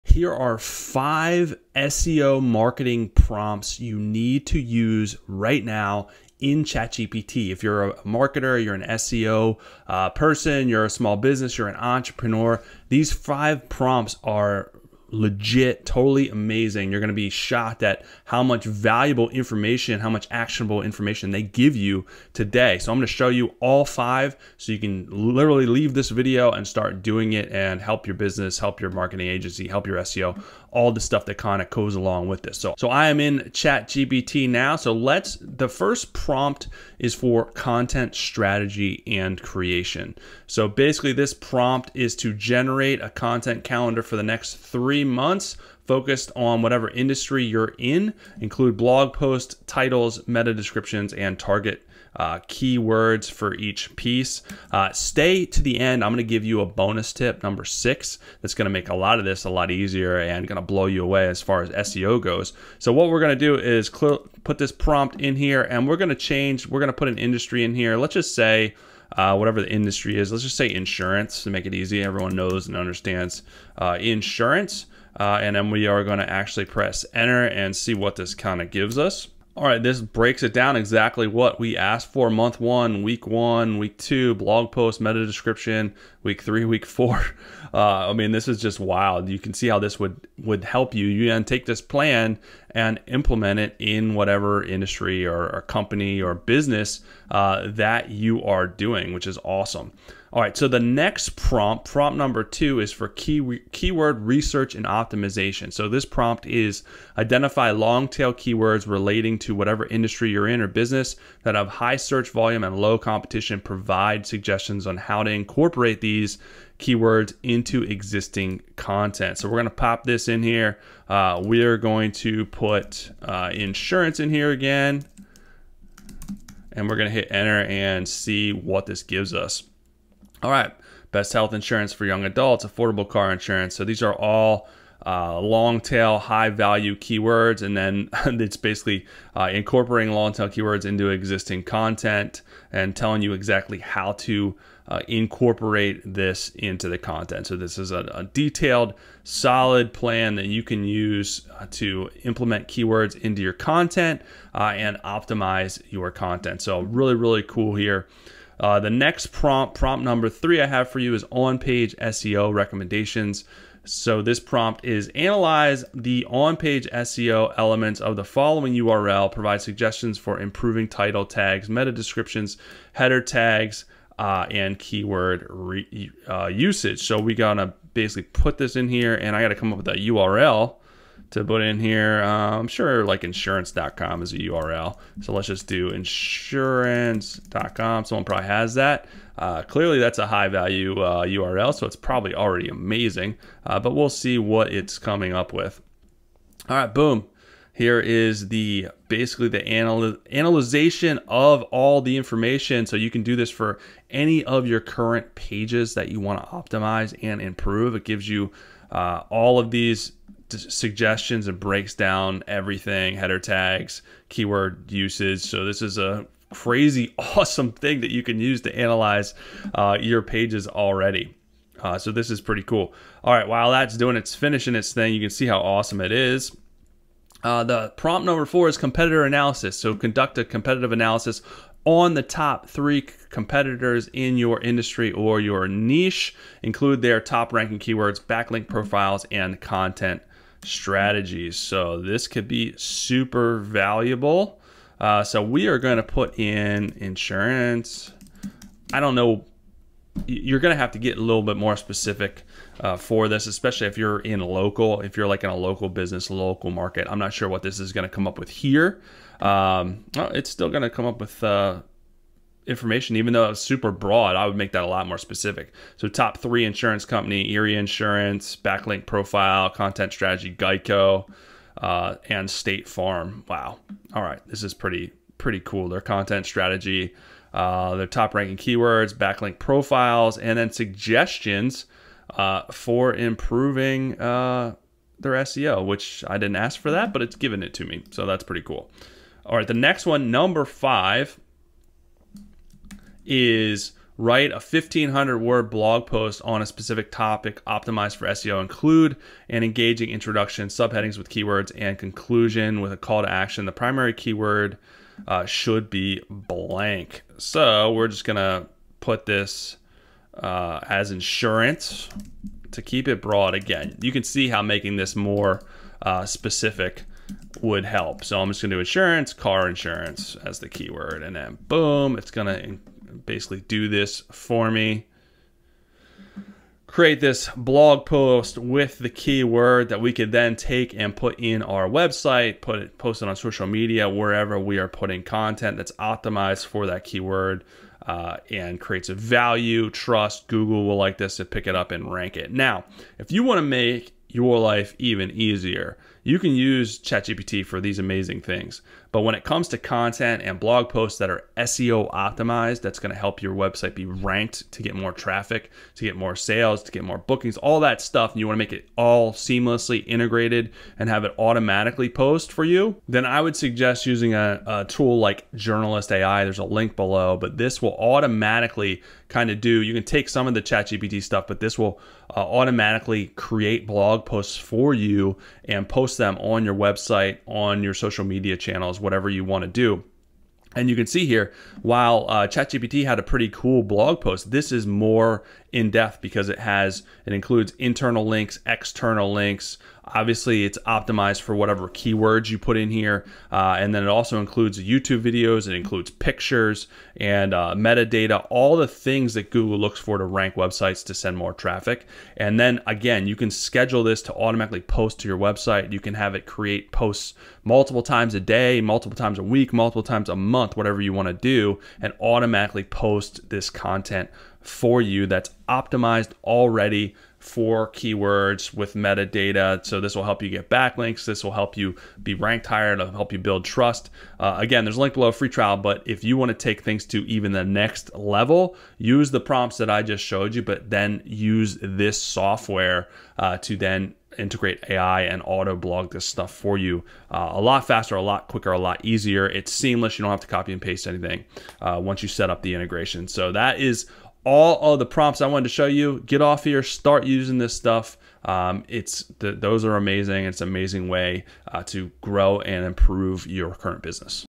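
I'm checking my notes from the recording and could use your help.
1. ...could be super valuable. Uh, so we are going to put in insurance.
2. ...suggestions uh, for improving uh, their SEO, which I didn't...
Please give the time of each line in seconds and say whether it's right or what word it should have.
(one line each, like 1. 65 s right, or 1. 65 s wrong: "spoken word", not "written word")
1. 242 s right
2. 280 s right.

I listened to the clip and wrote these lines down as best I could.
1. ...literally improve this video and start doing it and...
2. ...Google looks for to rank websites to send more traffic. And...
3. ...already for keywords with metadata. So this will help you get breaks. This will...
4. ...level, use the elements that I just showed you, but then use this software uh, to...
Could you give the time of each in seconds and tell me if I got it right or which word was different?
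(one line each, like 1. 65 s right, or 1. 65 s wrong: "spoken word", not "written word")
1. 25 s wrong: "leave", not "improve"
2. 399 s right
3. 416 s wrong: "backlinks", not "breaks"
4. 428 s wrong: "prompts", not "elements".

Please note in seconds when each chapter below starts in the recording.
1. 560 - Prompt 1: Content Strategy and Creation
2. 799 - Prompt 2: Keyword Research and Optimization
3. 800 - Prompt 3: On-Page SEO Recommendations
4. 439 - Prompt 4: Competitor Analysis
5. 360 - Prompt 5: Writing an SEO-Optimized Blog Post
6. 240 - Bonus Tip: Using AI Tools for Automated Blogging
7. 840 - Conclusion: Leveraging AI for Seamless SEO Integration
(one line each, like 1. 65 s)
1. 23 s
2. 101 s
3. 158 s
4. 223 s
5. 292 s
6. 343 s
7. 406 s.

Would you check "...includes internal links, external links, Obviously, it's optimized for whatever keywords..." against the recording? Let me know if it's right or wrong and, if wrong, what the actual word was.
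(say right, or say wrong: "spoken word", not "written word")
right.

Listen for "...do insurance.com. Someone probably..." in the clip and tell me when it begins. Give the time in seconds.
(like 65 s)
185 s.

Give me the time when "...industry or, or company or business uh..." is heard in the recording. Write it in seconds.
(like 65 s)
94 s.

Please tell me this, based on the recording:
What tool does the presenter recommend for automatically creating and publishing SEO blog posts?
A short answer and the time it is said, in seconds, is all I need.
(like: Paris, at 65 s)
Journalist AI, at 365 s.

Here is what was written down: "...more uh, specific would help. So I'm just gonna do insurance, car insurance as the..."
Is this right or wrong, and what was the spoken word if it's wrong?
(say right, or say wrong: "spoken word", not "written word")
right.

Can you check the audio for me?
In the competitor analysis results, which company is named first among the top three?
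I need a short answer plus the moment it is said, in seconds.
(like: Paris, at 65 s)
Erie Insurance, at 267 s.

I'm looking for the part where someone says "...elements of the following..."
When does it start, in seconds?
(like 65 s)
167 s.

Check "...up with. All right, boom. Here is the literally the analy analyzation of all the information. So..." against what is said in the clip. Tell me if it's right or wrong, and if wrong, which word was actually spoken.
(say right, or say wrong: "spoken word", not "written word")
wrong: "basically", not "literally".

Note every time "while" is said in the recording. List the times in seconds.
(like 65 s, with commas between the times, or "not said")
223 s, 381 s.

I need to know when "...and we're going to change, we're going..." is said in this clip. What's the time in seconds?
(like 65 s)
65 s.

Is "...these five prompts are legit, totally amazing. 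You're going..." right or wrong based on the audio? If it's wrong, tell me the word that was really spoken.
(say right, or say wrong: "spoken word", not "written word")
right.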